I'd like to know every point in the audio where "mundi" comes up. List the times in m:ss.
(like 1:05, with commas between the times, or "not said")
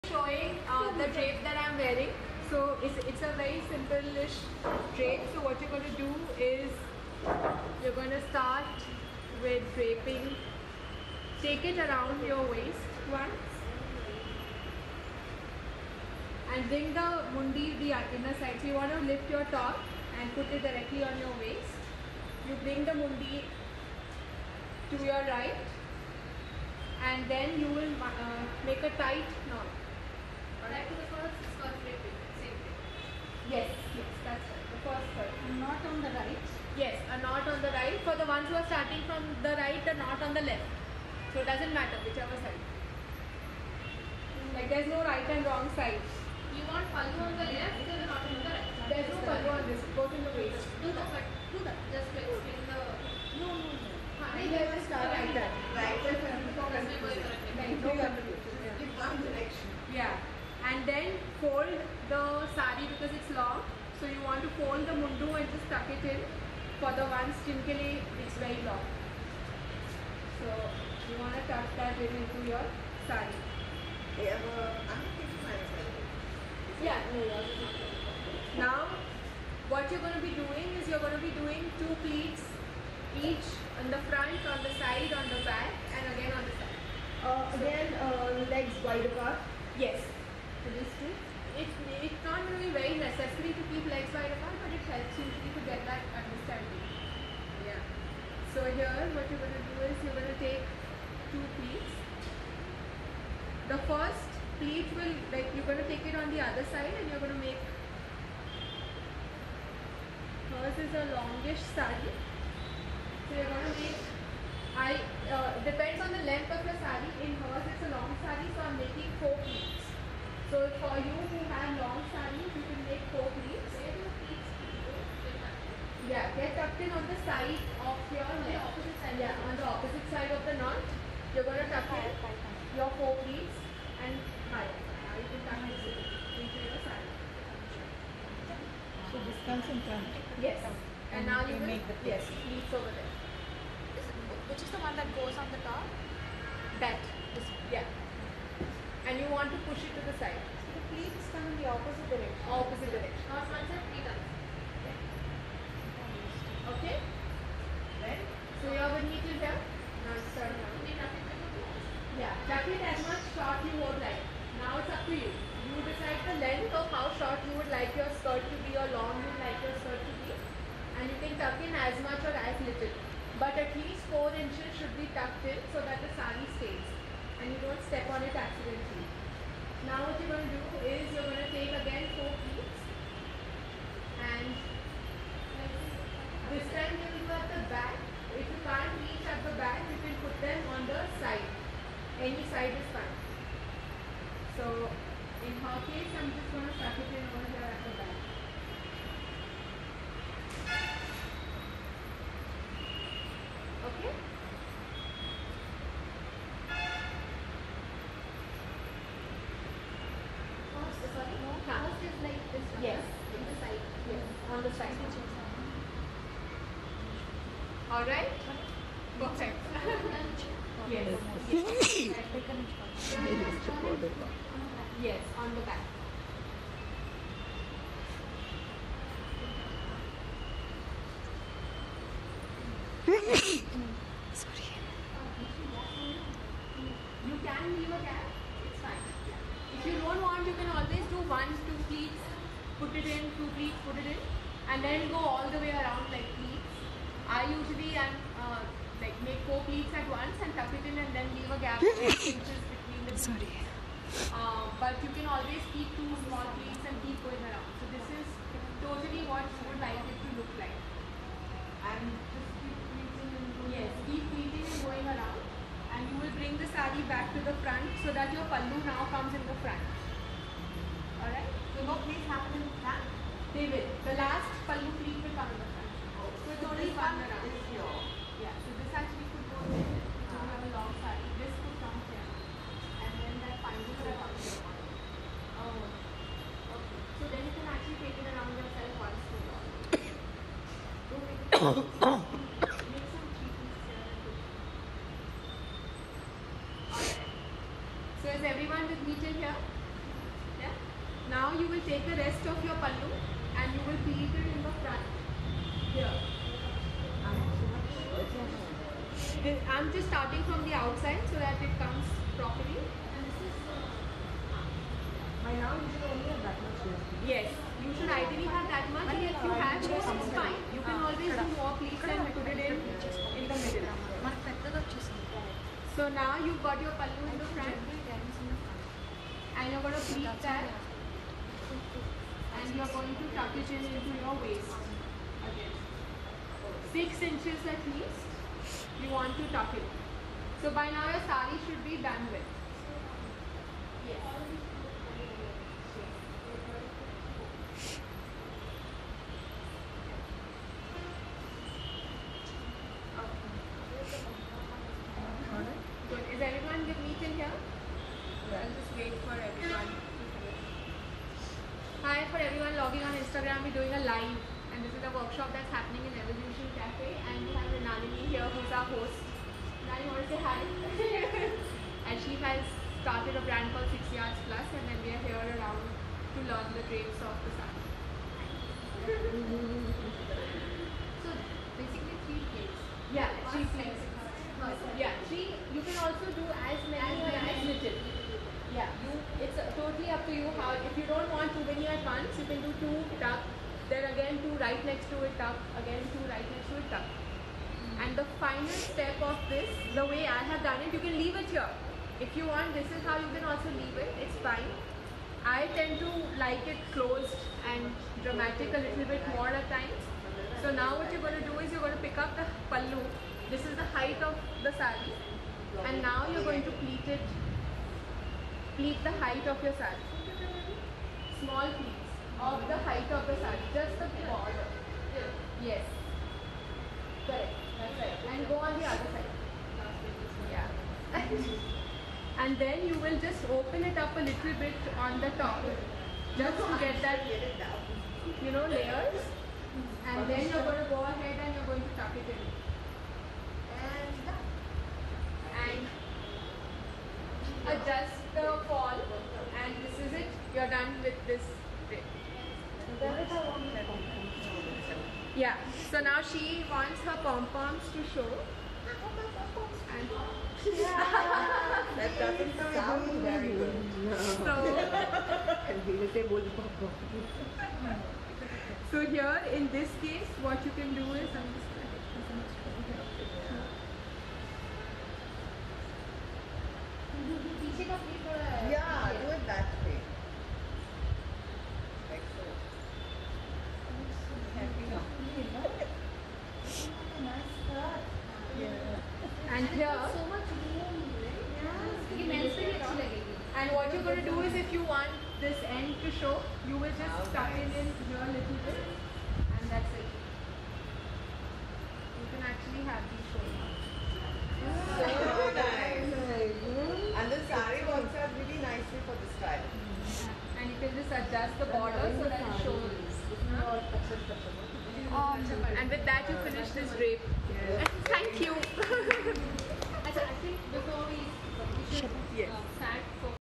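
0:17, 0:22.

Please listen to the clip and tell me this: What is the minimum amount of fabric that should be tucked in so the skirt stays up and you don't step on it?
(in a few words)
4 inches.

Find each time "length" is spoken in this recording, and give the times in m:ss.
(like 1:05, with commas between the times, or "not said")
1:56, 2:46.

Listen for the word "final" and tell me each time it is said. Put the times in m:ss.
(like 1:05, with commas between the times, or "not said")
4:43, 6:38.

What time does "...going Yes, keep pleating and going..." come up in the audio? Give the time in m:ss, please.
4:23.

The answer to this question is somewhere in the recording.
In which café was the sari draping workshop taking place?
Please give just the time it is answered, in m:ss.
6:06.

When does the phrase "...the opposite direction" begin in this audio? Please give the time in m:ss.
2:31.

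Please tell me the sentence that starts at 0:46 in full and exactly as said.
You want follow on the left, there's a knot on the right.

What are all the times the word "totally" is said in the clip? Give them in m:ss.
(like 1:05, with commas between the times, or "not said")
4:18, 6:29.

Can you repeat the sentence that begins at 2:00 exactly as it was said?
So for you who have long sarees, you can make four pleats.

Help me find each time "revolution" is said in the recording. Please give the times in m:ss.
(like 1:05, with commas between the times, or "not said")
not said.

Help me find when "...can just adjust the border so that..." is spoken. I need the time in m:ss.
8:30.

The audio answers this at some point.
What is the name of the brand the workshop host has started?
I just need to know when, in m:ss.
6:13.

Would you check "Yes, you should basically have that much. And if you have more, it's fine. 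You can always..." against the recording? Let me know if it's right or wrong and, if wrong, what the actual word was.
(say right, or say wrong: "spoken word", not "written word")
wrong: "ideally", not "basically".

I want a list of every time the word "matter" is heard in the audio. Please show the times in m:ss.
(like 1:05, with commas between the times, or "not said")
0:41.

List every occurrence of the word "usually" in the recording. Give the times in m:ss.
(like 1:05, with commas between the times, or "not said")
1:35, 4:07.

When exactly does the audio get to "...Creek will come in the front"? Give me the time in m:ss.
4:35.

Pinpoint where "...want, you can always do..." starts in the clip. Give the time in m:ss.
4:00.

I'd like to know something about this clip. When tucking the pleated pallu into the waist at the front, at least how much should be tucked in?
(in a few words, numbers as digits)
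6 inches.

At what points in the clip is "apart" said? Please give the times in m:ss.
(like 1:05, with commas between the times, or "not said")
1:29, 1:34.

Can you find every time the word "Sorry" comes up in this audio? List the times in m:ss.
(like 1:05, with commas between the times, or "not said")
3:54, 4:13.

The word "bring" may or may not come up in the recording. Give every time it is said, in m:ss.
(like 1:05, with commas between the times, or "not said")
0:16, 0:22, 4:26.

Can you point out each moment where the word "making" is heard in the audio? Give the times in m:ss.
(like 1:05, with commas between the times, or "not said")
1:58.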